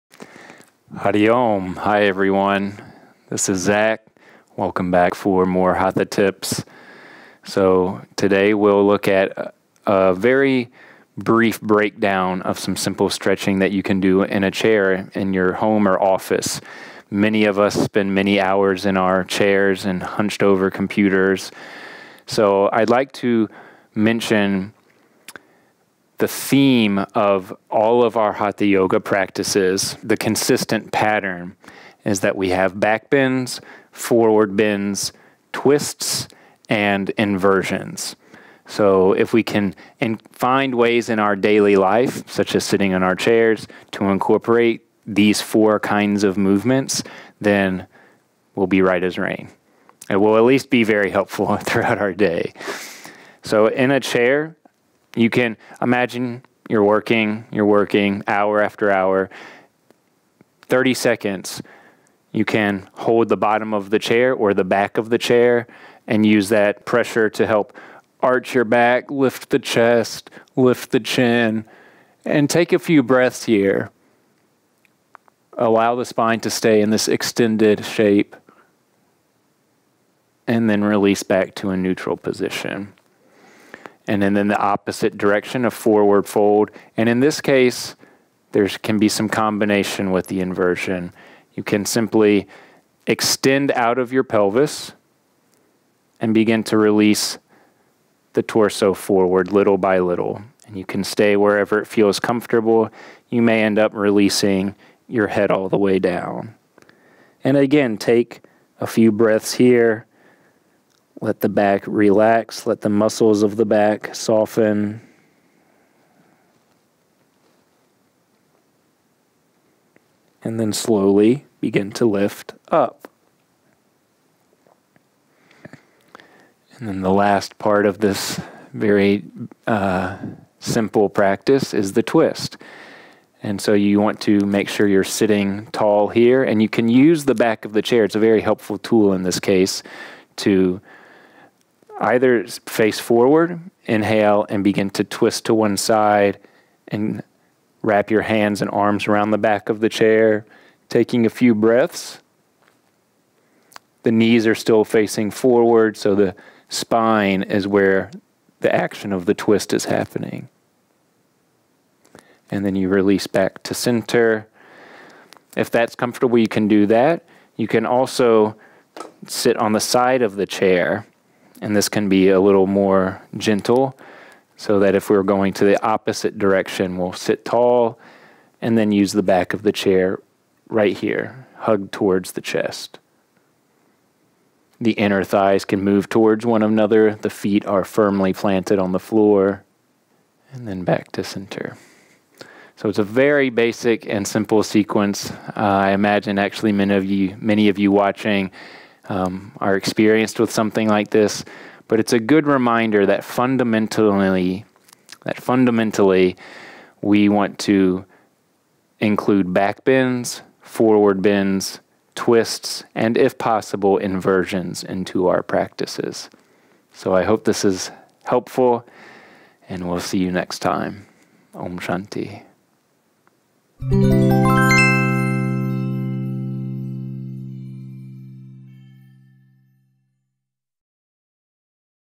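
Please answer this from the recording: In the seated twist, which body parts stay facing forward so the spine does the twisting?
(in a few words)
The knees.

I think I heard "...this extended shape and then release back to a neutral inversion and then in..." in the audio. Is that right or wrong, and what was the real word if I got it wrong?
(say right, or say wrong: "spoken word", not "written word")
wrong: "position", not "inversion".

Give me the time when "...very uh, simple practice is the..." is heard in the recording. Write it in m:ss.
2:08.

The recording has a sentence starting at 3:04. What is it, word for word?
The inner thighs can move towards one another.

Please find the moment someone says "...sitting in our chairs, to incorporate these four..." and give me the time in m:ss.
0:42.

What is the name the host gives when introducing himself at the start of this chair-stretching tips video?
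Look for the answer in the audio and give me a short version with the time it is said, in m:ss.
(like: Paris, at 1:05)
Zac, at 0:03.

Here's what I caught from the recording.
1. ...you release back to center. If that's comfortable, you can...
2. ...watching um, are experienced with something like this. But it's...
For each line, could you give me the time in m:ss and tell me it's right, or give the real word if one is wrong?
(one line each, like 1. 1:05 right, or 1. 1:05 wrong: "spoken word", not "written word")
1. 2:42 right
2. 3:17 right.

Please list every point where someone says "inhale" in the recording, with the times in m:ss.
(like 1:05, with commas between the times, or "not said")
2:23.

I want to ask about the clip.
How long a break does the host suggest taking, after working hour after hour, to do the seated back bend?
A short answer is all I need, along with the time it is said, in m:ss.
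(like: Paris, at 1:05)
30 seconds, at 1:00.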